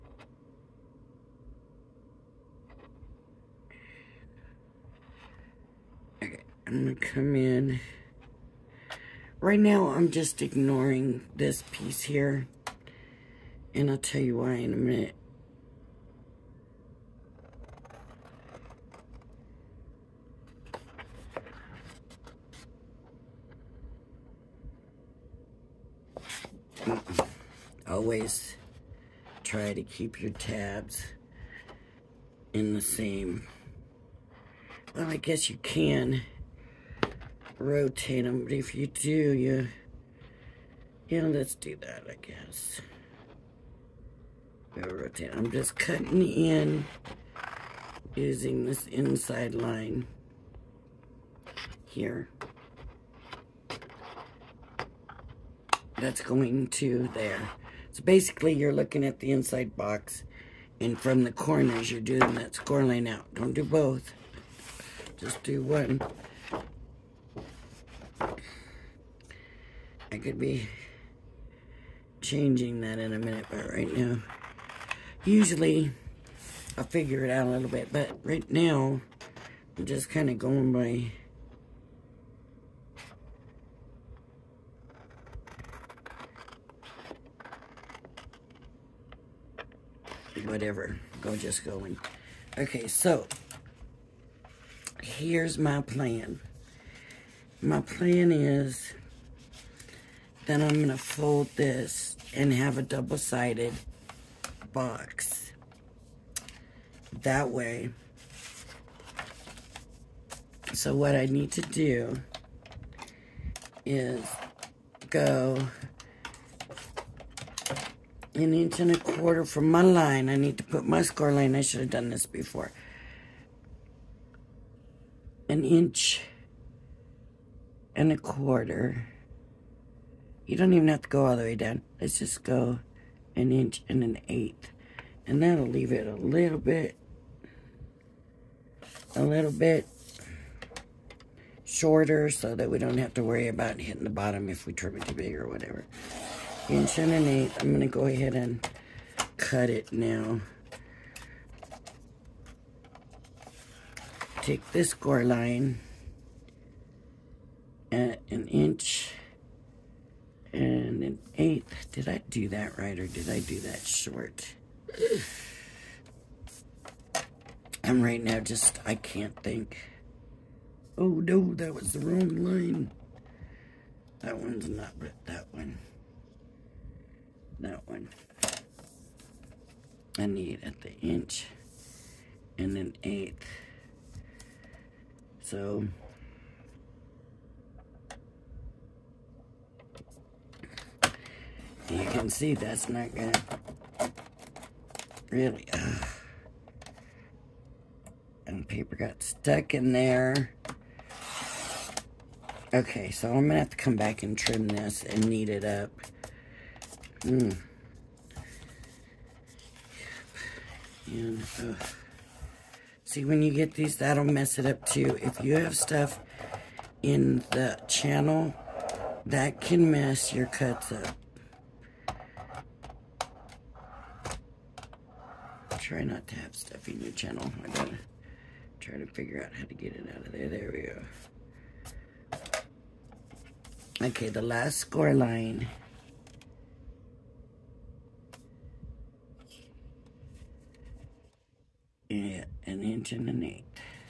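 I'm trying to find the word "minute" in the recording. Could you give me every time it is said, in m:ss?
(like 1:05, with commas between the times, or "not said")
0:14, 1:13.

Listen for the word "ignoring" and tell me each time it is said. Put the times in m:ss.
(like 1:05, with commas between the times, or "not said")
0:10.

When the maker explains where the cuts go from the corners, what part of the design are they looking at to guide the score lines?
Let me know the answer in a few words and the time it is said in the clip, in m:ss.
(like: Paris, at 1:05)
the inside box, at 0:59.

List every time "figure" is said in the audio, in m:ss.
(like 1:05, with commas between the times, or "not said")
1:16, 3:49.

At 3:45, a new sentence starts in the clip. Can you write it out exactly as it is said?
Try not to have stuff in your channel.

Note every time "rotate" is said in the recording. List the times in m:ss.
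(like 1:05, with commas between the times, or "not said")
0:37, 0:44.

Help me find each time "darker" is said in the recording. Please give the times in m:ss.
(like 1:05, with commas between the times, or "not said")
not said.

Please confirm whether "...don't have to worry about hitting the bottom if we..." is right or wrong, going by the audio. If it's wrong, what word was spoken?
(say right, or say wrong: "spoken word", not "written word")
right.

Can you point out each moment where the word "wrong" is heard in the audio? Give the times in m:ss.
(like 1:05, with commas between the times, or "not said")
2:51.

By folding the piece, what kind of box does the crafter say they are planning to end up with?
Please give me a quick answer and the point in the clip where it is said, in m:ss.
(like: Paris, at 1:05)
double-sided box, at 1:42.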